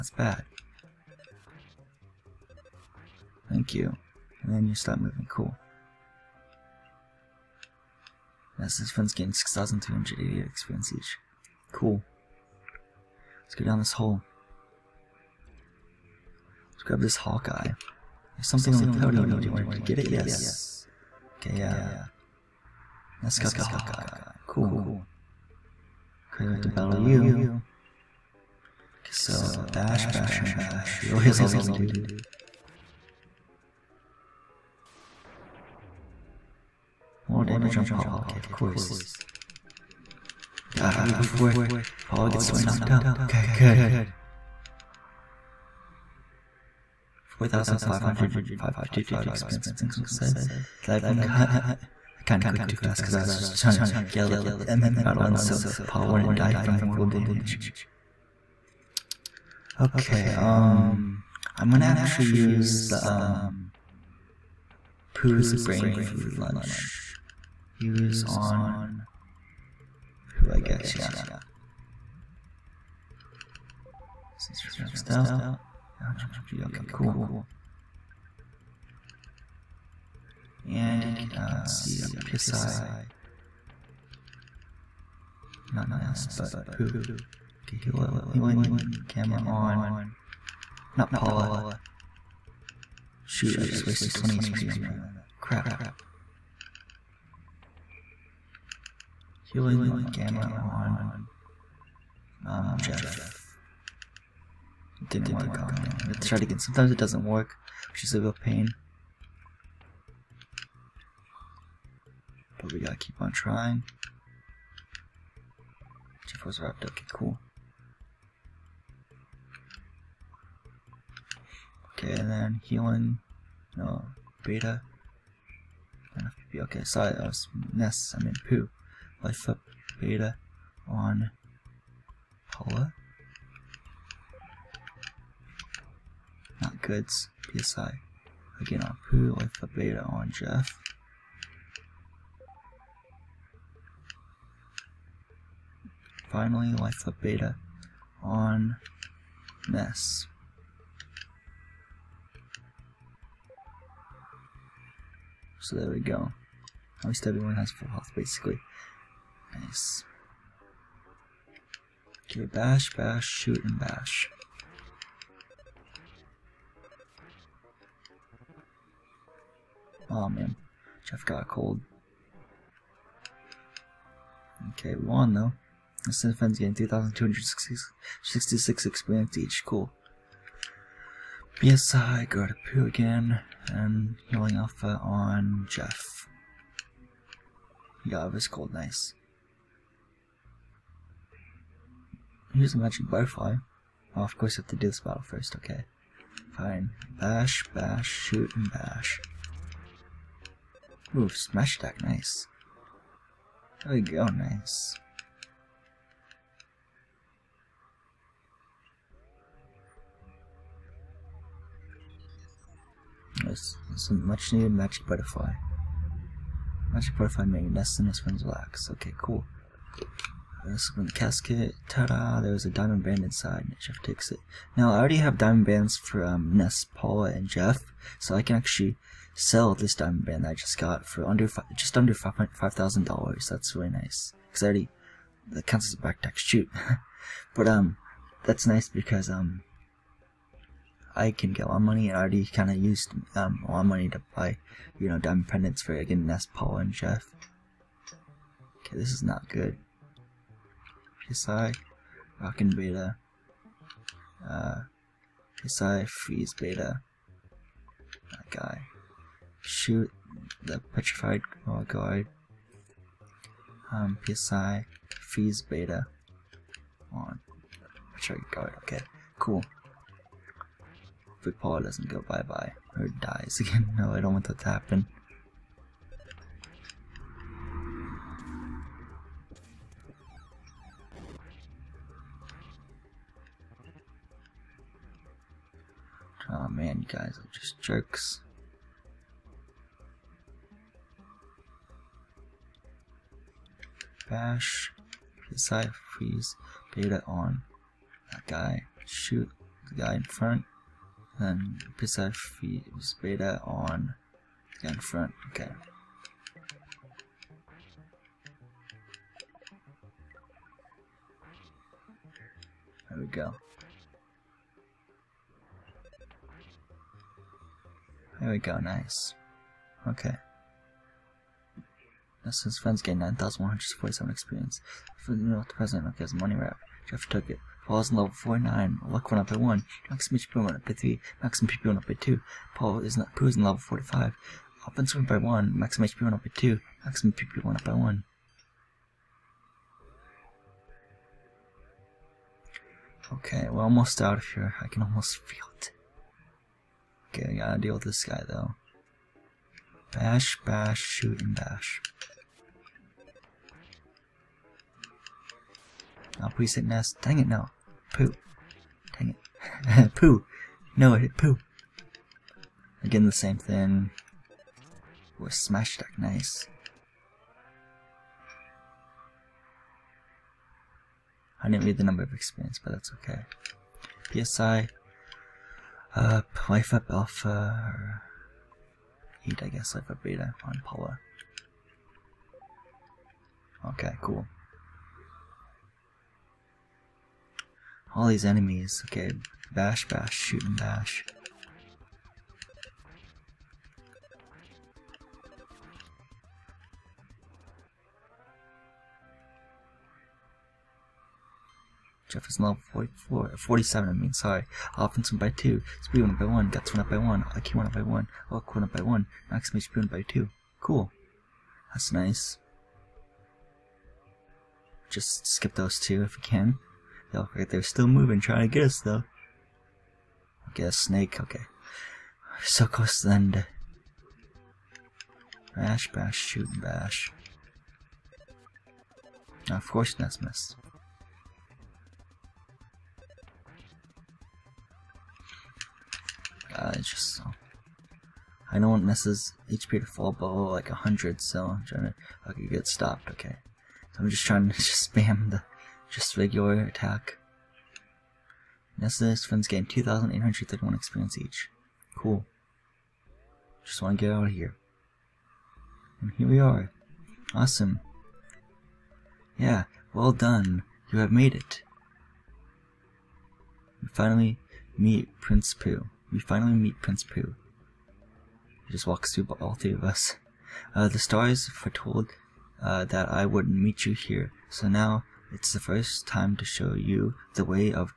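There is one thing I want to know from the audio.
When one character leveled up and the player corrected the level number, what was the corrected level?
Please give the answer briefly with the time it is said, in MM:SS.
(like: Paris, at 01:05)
47, at 06:43.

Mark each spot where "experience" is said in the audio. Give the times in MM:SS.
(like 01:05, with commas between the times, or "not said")
00:10, 00:49, 02:58, 05:24, 06:12, 07:30.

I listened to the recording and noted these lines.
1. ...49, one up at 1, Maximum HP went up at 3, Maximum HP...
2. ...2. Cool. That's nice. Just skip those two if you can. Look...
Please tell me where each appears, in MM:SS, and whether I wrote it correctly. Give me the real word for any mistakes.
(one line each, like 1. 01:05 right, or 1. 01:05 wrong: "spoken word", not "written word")
1. 05:28 right
2. 06:50 right.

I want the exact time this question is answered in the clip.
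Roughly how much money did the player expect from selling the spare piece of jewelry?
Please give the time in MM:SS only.
03:51.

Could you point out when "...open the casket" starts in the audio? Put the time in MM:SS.
03:41.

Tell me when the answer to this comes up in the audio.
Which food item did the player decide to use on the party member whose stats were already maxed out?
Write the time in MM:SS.
01:05.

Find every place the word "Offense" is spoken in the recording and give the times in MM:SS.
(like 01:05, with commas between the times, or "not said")
05:34, 06:44.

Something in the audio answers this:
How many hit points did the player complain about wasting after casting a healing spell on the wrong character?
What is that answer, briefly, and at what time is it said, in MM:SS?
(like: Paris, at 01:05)
20, at 01:34.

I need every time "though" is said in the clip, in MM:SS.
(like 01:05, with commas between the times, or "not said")
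02:55, 05:48, 06:59.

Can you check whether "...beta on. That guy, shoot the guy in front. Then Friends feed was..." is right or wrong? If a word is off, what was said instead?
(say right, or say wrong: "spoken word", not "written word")
wrong: "PSI", not "Friends".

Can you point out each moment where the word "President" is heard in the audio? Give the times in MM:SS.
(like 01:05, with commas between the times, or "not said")
05:25.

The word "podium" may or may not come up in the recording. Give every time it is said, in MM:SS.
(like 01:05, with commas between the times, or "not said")
00:18.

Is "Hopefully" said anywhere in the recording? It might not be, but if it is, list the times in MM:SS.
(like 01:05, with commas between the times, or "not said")
04:31.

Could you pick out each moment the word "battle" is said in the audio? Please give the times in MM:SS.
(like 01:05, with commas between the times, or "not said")
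00:26, 00:55, 03:15.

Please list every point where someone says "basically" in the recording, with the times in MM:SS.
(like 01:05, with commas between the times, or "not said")
02:38.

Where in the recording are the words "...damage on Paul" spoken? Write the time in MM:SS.
00:37.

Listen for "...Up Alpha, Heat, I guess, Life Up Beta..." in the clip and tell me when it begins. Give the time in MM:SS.
06:16.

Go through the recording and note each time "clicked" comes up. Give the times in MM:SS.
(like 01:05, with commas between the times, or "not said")
00:52.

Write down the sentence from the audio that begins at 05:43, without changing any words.
Okay, we're almost out of here.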